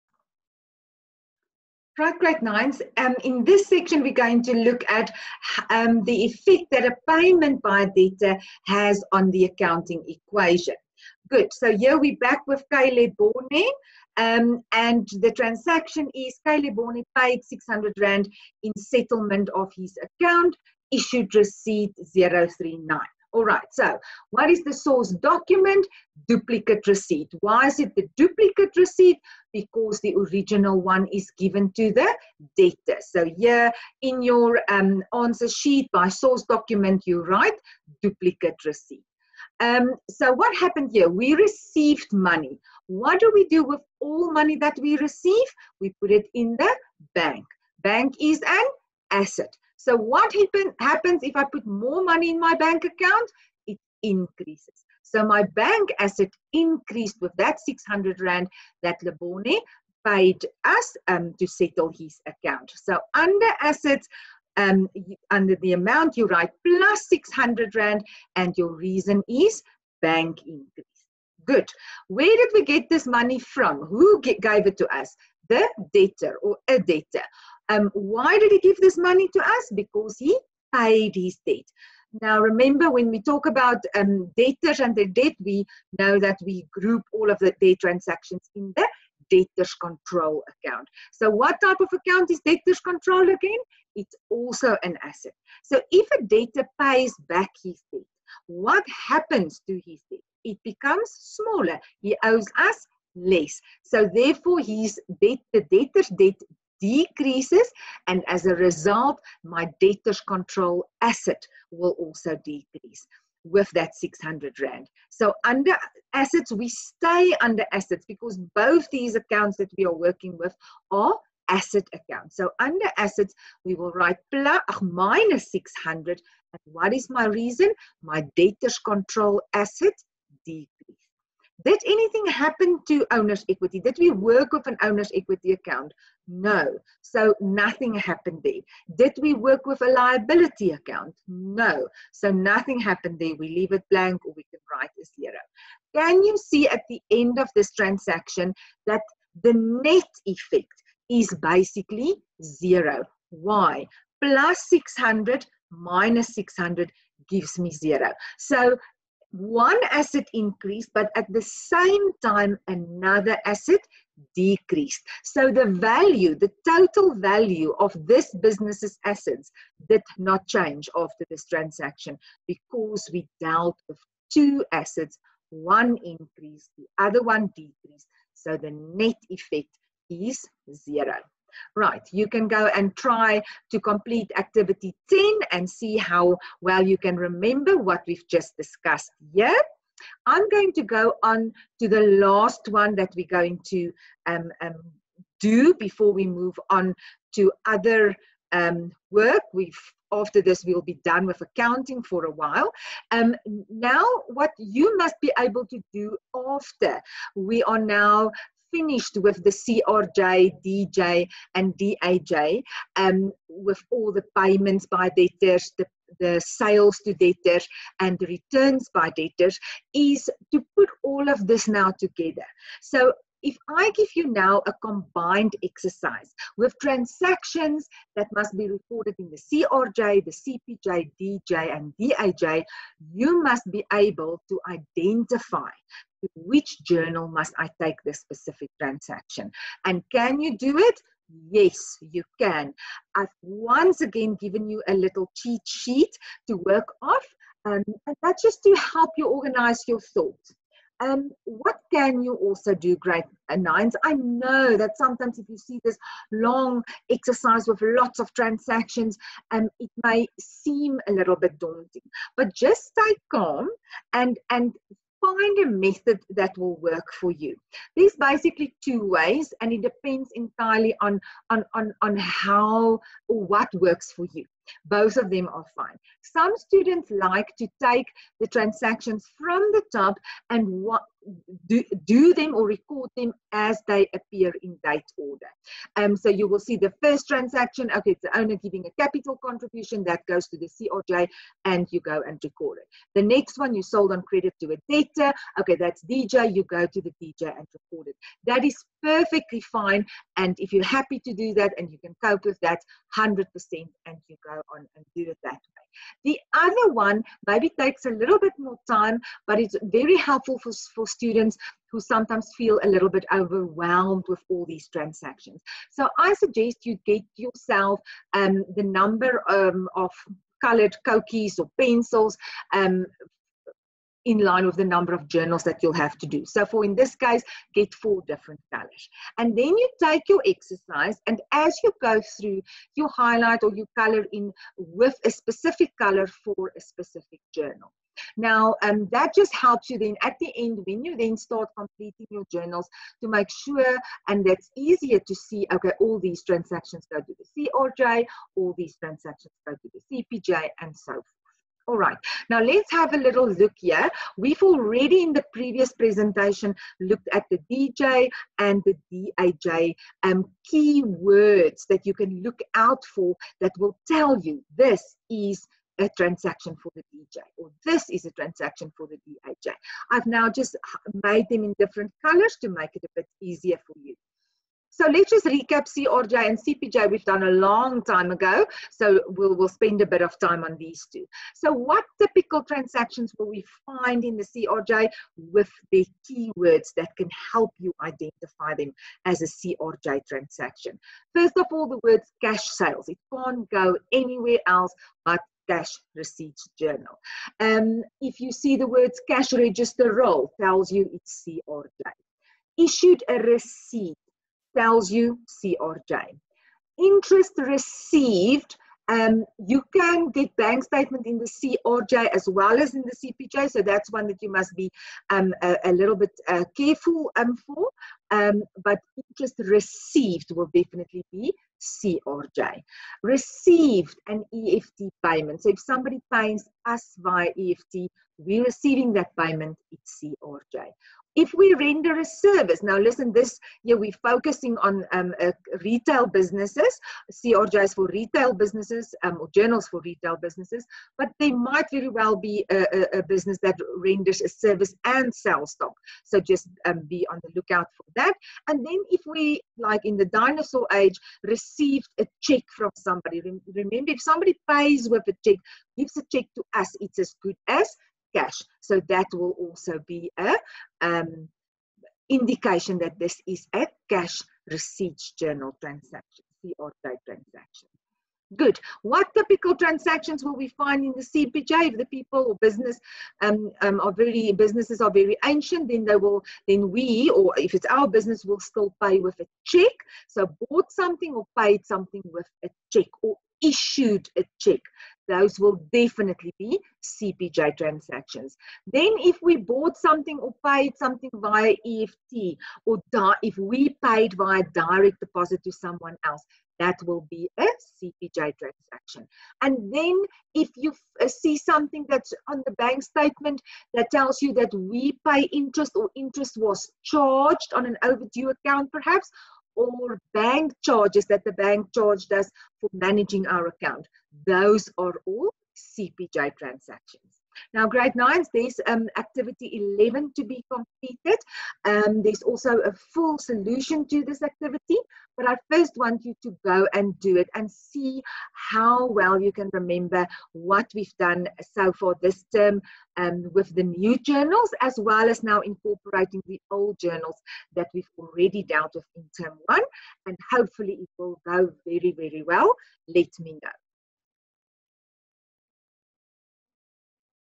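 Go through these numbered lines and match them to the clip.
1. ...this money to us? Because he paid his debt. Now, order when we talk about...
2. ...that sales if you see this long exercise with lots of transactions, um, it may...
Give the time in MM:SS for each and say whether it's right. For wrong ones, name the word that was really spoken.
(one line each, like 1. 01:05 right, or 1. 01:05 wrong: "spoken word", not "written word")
1. 01:18 wrong: "remember", not "order"
2. 04:14 wrong: "sometimes", not "sales".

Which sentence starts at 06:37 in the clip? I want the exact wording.
Um, if you see the words cash register roll, tells you it's CRJ.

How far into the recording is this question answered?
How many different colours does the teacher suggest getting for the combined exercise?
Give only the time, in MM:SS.
05:27.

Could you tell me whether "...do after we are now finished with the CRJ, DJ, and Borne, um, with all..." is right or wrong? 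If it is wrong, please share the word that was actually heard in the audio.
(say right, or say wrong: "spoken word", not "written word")
wrong: "DAJ", not "Borne".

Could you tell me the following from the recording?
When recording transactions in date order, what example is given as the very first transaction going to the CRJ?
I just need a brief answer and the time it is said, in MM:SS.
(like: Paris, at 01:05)
Capital contribution, at 04:49.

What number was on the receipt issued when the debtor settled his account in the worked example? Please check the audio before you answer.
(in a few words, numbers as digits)
039.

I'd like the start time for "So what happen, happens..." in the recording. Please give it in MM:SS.
00:49.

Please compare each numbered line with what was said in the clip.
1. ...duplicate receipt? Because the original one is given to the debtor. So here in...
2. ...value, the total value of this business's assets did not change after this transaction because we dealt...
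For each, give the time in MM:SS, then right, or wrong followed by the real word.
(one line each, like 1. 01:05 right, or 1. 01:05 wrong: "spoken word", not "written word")
1. 00:28 right
2. 02:45 right.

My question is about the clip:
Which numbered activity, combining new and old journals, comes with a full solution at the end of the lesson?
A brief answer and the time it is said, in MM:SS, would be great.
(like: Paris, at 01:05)
Activity 11, at 08:39.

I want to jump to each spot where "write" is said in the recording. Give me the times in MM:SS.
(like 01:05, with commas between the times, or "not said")
00:37, 01:06, 02:03, 02:24.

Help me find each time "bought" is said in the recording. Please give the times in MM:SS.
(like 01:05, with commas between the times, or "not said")
08:00, 08:09.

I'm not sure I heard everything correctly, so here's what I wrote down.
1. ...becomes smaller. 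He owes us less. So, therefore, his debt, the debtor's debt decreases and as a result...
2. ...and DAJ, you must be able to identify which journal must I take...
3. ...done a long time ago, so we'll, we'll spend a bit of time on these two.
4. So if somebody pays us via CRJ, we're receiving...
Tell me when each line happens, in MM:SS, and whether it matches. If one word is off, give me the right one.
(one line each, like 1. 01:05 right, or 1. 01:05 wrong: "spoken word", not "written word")
1. 01:40 right
2. 03:51 right
3. 06:17 right
4. 07:05 wrong: "EFT", not "CRJ".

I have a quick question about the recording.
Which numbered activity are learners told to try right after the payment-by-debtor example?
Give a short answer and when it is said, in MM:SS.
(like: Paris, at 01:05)
Activity 10, at 03:04.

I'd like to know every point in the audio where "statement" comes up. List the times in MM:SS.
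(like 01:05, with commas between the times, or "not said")
06:50, 08:23.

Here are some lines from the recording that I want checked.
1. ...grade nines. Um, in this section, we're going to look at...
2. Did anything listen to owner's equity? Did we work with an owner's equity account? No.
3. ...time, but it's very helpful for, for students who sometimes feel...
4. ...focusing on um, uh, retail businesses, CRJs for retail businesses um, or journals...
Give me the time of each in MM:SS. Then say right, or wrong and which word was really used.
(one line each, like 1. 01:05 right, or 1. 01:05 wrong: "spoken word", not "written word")
1. 00:02 right
2. 02:11 wrong: "happen", not "listen"
3. 05:08 right
4. 07:14 right.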